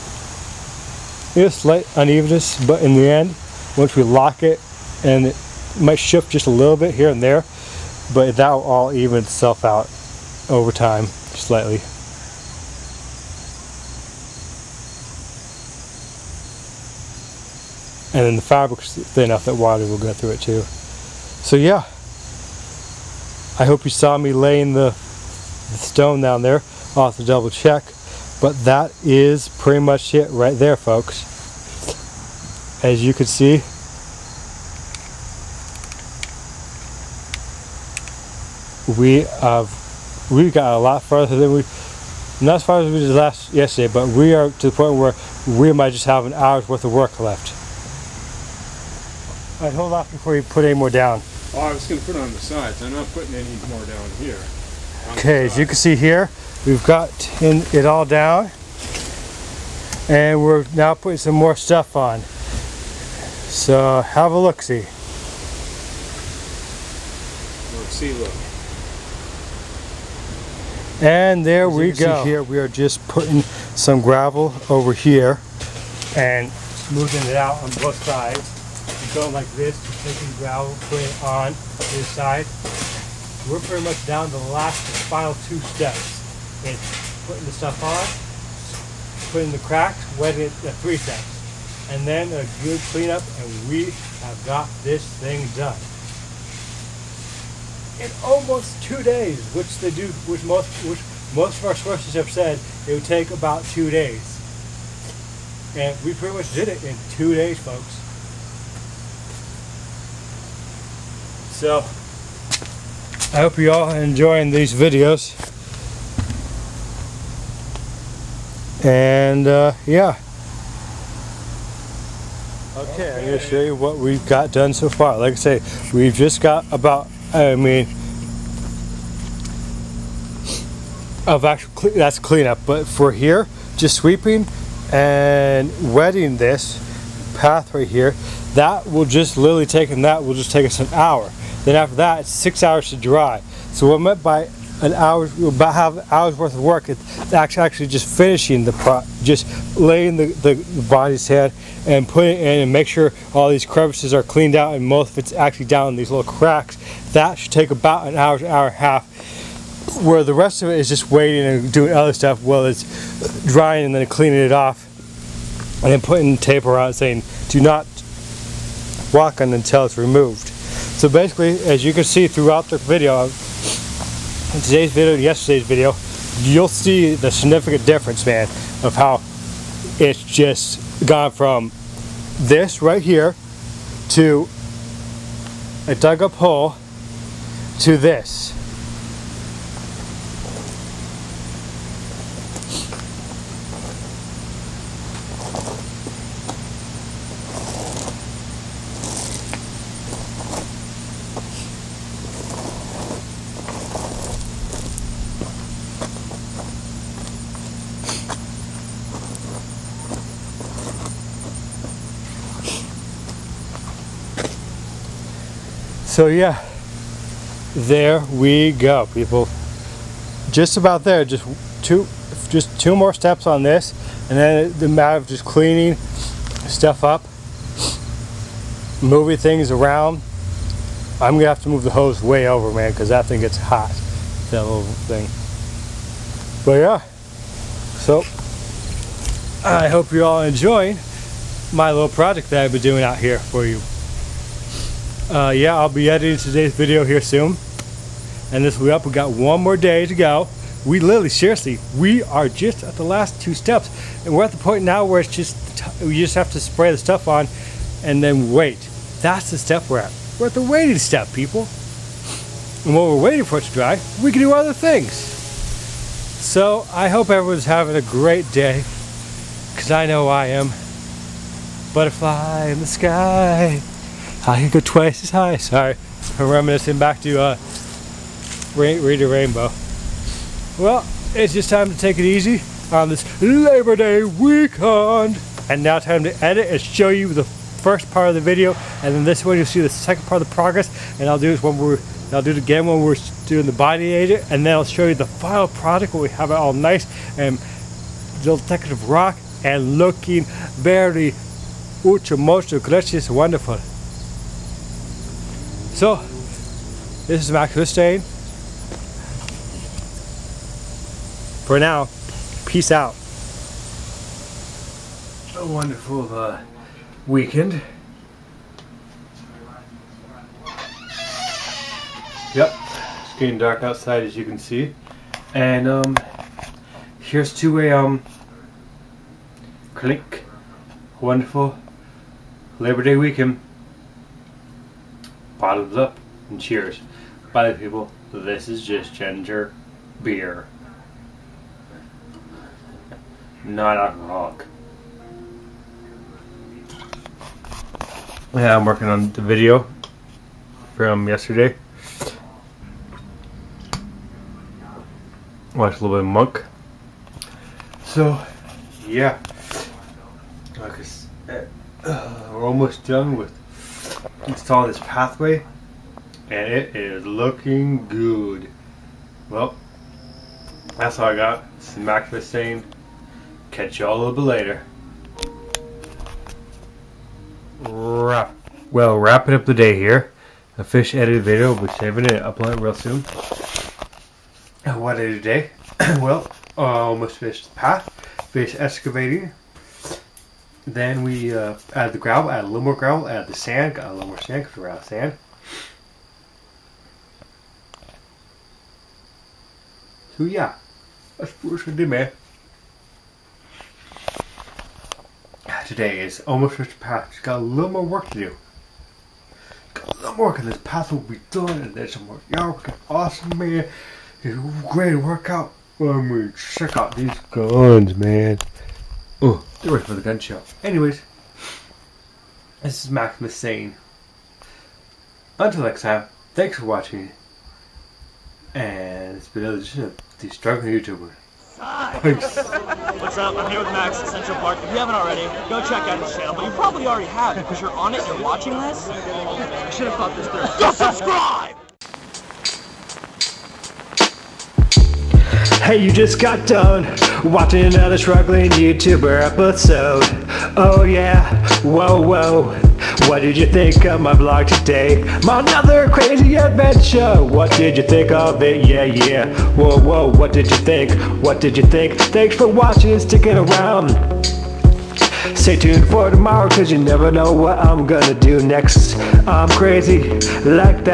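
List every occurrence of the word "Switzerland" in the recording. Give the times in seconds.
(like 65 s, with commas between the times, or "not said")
not said.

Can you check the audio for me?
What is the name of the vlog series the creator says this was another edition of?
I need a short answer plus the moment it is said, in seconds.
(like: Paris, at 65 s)
The Struggling YouTuber, at 430 s.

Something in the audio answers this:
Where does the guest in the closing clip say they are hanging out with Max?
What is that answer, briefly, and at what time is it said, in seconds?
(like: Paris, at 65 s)
Central Park, at 434 s.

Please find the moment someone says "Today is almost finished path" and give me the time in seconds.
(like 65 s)
405 s.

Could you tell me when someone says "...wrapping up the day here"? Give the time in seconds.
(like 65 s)
379 s.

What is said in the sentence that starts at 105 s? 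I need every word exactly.
And we pretty much did it in two days, folks.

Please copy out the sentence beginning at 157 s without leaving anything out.
That should take about an hour, hour and a half.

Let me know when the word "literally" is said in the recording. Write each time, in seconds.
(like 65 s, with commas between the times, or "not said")
139 s, 250 s.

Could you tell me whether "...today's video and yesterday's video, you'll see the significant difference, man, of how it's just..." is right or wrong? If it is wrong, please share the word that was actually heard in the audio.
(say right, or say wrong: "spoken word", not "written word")
right.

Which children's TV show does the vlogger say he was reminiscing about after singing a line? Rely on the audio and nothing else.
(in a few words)
Reading Rainbow.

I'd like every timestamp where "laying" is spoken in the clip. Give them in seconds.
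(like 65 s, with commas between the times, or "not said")
24 s, 149 s.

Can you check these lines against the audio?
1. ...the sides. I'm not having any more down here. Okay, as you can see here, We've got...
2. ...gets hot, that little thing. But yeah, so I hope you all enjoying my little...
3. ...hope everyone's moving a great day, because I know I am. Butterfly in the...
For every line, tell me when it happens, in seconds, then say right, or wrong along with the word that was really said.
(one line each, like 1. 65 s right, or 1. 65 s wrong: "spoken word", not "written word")
1. 52 s wrong: "putting", not "having"
2. 233 s right
3. 267 s wrong: "having", not "moving".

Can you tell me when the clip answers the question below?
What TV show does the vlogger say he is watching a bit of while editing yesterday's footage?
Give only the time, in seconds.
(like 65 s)
356 s.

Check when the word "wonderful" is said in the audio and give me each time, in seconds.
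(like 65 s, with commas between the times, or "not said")
303 s, 315 s, 331 s.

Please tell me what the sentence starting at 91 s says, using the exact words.
And then a good cleanup, and we have got this thing done.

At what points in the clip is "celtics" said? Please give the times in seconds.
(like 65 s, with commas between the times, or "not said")
not said.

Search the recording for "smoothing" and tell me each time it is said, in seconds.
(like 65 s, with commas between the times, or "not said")
76 s.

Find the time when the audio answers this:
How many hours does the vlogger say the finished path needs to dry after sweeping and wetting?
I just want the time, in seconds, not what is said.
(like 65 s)
142 s.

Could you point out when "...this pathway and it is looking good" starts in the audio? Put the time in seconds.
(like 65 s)
364 s.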